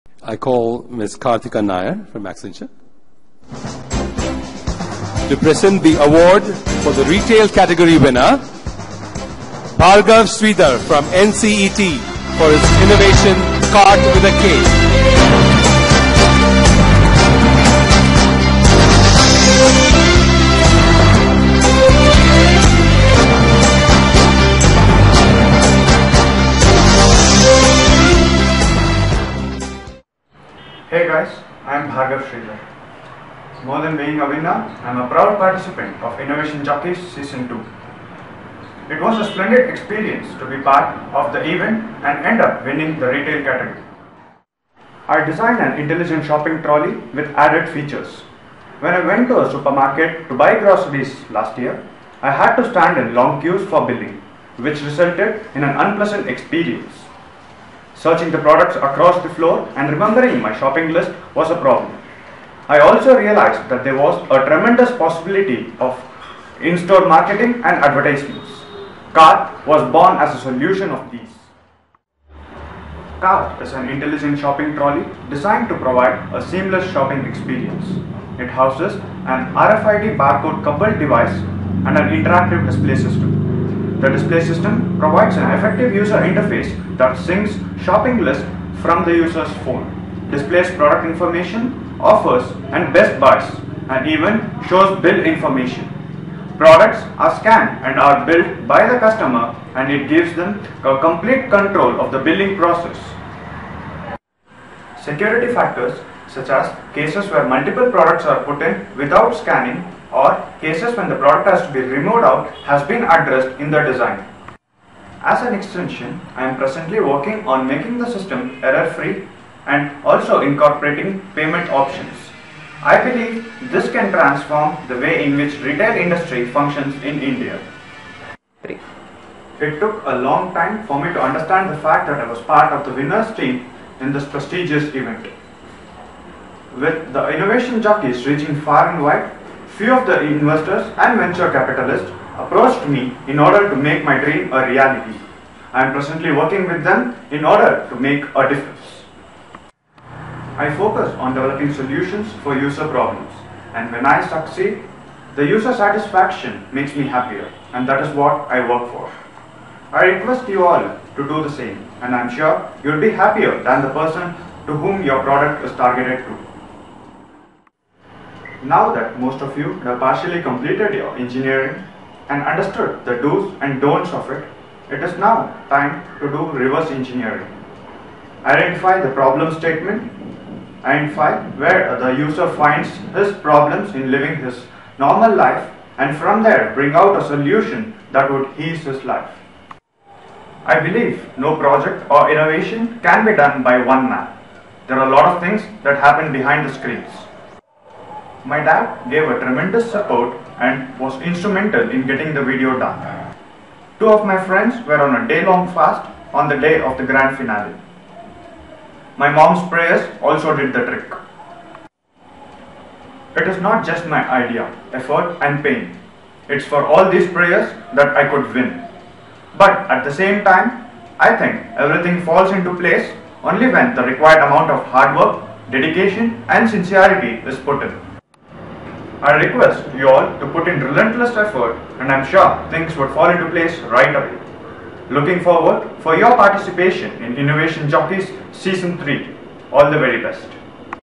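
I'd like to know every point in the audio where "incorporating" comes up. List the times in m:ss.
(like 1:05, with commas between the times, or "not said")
2:00.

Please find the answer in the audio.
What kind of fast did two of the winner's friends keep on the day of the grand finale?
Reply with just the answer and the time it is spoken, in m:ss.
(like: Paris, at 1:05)
day-long, at 3:25.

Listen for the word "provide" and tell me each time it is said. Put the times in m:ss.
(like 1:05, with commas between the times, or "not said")
1:15, 1:24.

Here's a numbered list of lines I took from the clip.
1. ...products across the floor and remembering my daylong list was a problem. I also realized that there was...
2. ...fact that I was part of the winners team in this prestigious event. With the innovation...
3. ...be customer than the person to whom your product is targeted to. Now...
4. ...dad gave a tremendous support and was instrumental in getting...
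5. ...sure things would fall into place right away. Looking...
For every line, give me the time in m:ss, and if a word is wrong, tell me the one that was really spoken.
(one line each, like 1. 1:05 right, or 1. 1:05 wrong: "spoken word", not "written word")
1. 0:58 wrong: "shopping", not "daylong"
2. 2:11 right
3. 2:42 wrong: "happier", not "customer"
4. 3:18 right
5. 3:52 right.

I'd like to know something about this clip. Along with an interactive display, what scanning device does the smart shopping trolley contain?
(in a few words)
RFID barcode.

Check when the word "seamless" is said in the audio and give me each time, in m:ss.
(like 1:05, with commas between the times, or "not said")
1:16.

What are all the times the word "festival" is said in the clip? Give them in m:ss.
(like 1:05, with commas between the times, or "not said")
not said.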